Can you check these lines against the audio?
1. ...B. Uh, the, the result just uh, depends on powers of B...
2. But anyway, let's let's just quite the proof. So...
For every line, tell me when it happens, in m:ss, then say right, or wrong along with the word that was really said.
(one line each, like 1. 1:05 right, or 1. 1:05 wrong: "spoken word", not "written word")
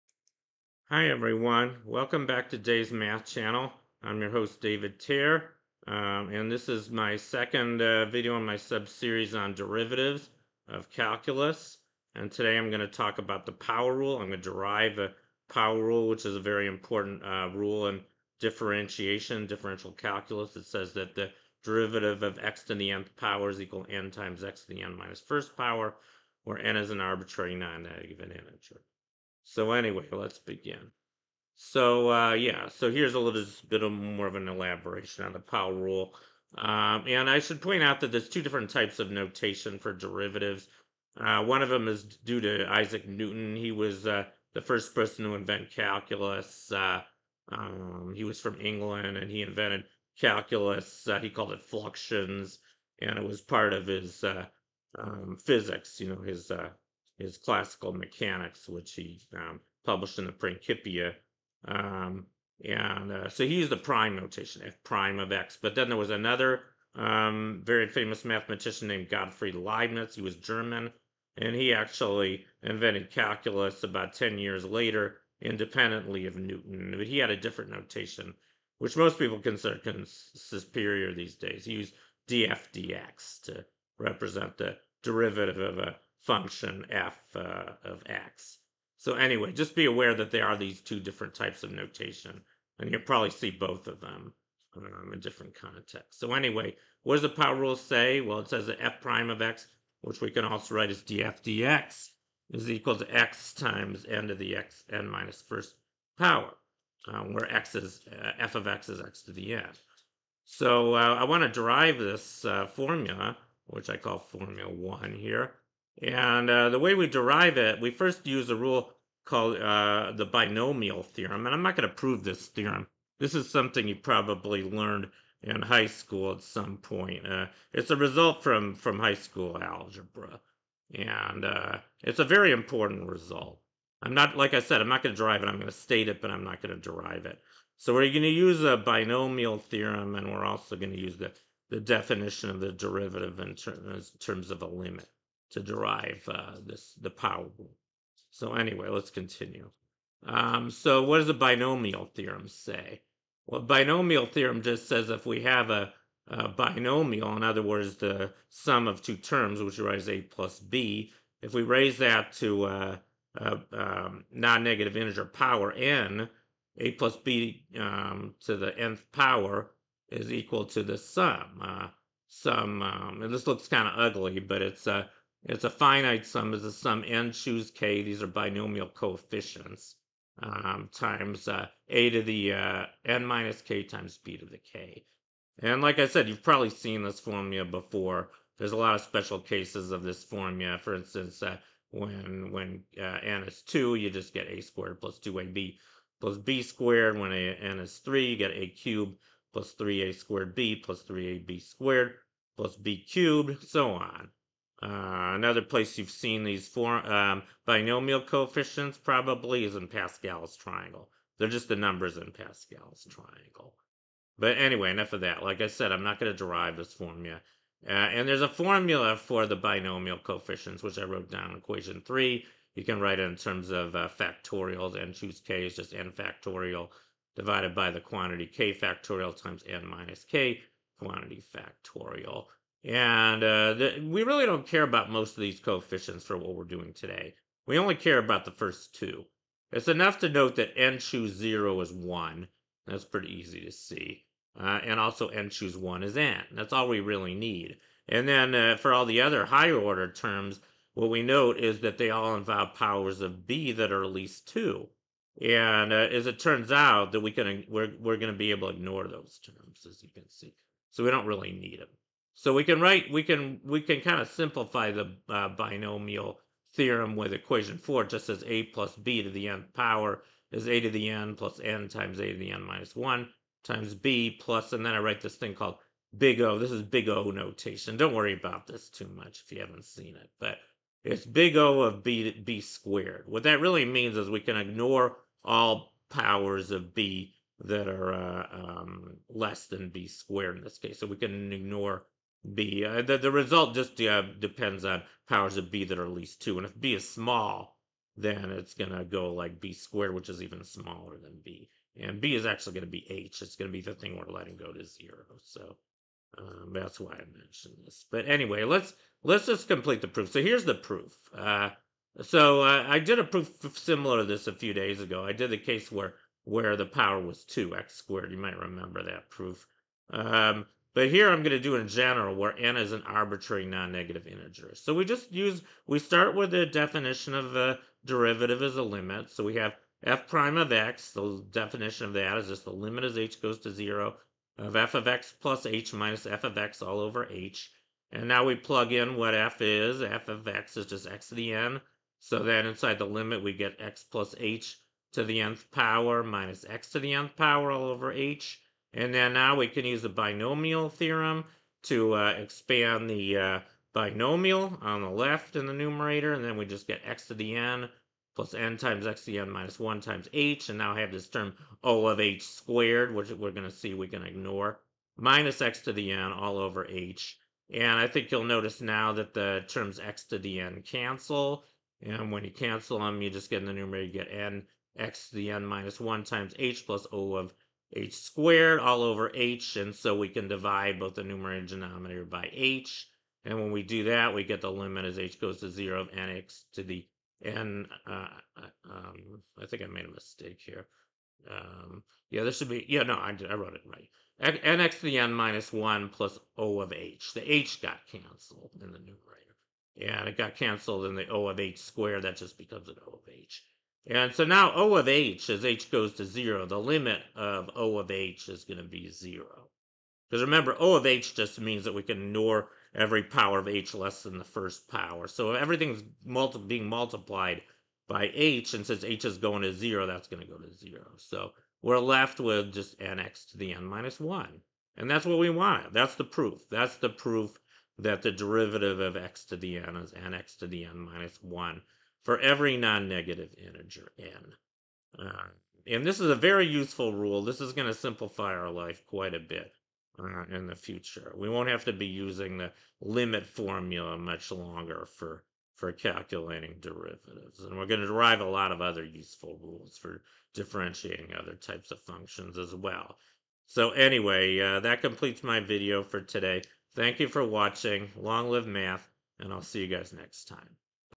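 1. 4:52 right
2. 5:08 wrong: "complete", not "quite".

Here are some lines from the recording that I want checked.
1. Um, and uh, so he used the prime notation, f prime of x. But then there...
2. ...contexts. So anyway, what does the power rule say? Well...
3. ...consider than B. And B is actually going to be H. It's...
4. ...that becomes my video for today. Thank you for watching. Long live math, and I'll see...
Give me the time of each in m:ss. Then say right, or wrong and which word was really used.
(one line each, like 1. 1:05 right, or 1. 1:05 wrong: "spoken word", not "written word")
1. 1:01 right
2. 1:35 right
3. 5:00 wrong: "smaller", not "consider"
4. 7:34 wrong: "completes", not "becomes".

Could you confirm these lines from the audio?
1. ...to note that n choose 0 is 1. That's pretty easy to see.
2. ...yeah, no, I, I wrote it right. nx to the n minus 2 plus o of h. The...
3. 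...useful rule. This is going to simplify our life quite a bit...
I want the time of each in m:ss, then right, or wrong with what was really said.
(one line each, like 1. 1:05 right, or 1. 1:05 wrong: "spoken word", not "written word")
1. 4:00 right
2. 6:32 wrong: "1", not "2"
3. 7:16 right.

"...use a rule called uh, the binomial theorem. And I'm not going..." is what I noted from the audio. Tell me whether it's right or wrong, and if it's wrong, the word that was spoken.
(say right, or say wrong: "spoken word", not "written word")
right.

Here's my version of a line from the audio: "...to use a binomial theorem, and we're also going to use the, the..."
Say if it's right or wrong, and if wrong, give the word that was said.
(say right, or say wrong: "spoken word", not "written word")
right.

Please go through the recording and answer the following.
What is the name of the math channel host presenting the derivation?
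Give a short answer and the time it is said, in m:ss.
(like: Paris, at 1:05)
David Tier, at 0:04.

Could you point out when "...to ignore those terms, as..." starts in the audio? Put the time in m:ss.
4:18.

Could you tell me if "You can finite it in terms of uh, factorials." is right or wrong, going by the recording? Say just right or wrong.
wrong.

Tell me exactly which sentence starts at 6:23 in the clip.
And when we do that, we get the limit as h goes to 0 of nx to the n.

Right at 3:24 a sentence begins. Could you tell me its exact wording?
Uh, another place you've seen these four, um, binomial coefficients probably is in Pascal's triangle.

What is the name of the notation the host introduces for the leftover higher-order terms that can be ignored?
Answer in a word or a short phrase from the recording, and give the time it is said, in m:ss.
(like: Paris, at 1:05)
big O notation, at 4:36.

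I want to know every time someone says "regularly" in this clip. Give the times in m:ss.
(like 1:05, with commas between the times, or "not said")
not said.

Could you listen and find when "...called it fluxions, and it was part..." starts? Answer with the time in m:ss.
0:51.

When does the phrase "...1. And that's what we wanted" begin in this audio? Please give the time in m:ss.
7:04.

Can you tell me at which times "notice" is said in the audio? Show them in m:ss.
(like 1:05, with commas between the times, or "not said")
6:08.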